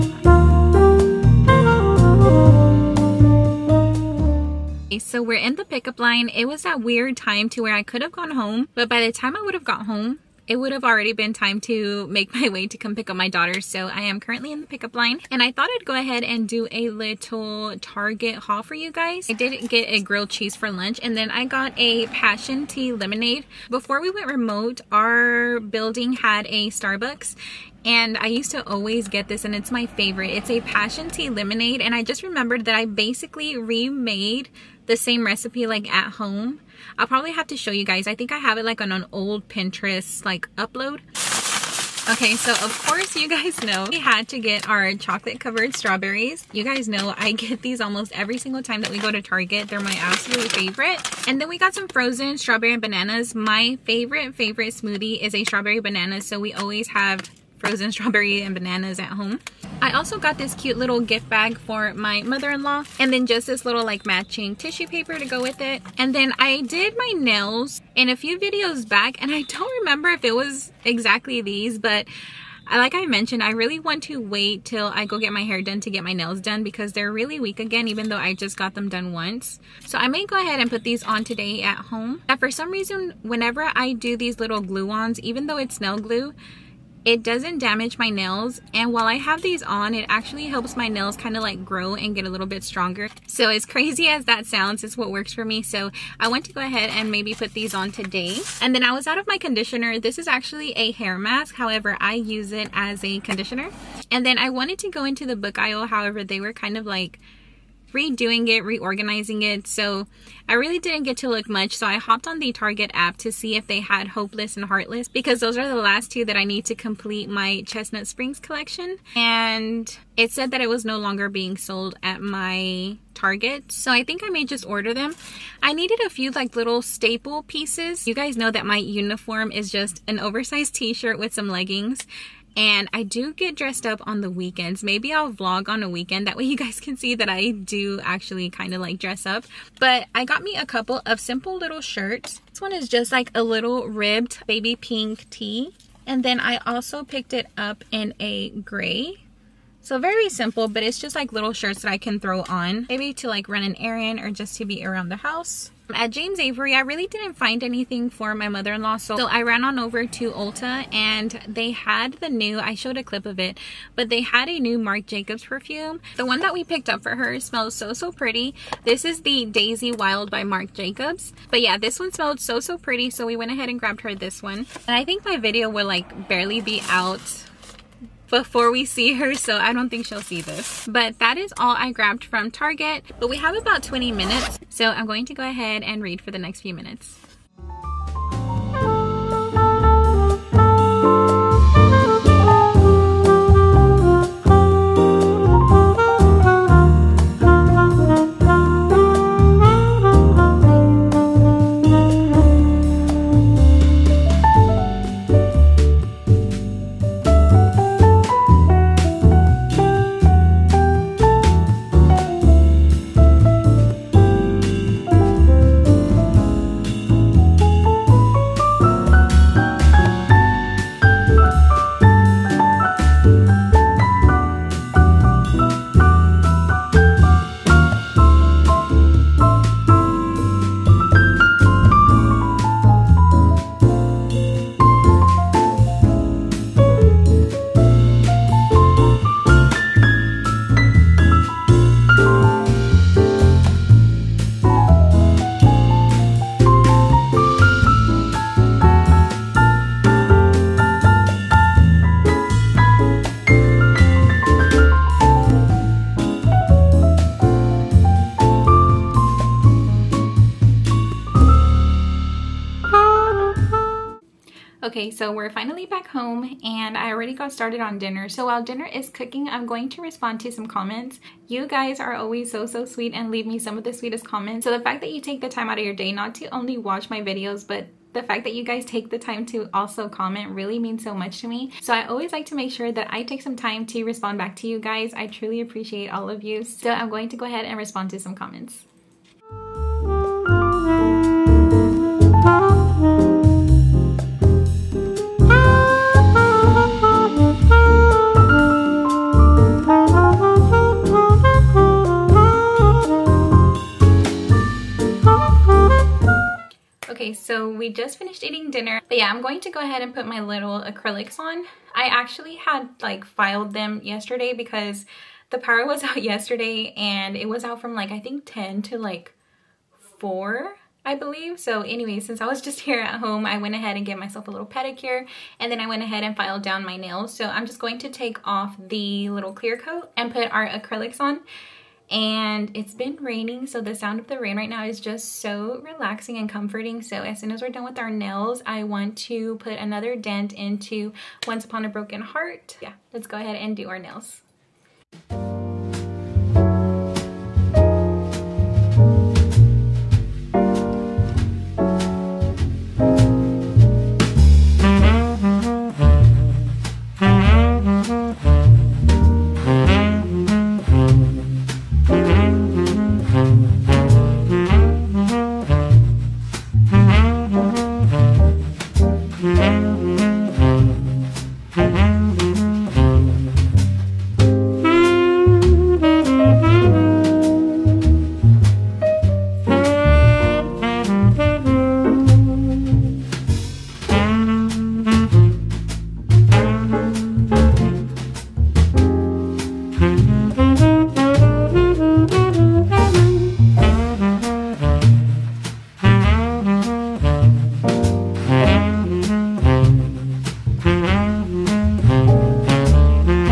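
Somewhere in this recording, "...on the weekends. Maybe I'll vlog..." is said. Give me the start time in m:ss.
2:14.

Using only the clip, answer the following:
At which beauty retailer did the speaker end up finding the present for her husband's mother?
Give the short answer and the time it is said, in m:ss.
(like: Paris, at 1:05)
Ulta, at 2:40.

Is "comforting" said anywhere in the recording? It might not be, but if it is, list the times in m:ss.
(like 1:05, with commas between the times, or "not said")
5:36.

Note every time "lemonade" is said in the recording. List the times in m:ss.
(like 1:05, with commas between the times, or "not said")
0:22, 0:31.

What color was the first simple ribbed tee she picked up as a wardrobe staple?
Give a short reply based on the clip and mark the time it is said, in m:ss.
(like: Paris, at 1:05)
Baby pink, at 2:24.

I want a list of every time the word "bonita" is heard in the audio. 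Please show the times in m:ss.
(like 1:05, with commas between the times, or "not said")
not said.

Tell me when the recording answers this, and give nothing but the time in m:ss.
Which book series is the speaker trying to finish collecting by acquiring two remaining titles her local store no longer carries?
1:57.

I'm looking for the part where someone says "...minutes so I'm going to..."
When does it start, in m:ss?
3:04.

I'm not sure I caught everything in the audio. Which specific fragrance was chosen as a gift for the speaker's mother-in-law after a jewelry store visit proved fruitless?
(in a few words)
Daisy Wild.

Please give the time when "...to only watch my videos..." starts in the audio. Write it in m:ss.
4:36.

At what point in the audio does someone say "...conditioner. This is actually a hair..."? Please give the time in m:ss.
1:39.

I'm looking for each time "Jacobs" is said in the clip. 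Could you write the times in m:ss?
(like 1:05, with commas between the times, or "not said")
2:45, 2:50.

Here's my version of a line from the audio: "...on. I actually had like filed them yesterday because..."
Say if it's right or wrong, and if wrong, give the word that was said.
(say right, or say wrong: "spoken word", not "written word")
right.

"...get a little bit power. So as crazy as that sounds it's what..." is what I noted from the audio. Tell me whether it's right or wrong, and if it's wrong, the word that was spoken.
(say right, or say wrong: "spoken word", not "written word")
wrong: "stronger", not "power".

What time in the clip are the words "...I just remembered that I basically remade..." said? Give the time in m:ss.
0:31.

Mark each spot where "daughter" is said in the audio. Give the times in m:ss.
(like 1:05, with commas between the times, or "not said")
0:13.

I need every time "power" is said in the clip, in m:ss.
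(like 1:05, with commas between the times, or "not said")
5:15.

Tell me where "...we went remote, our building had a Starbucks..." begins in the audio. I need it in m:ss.
0:24.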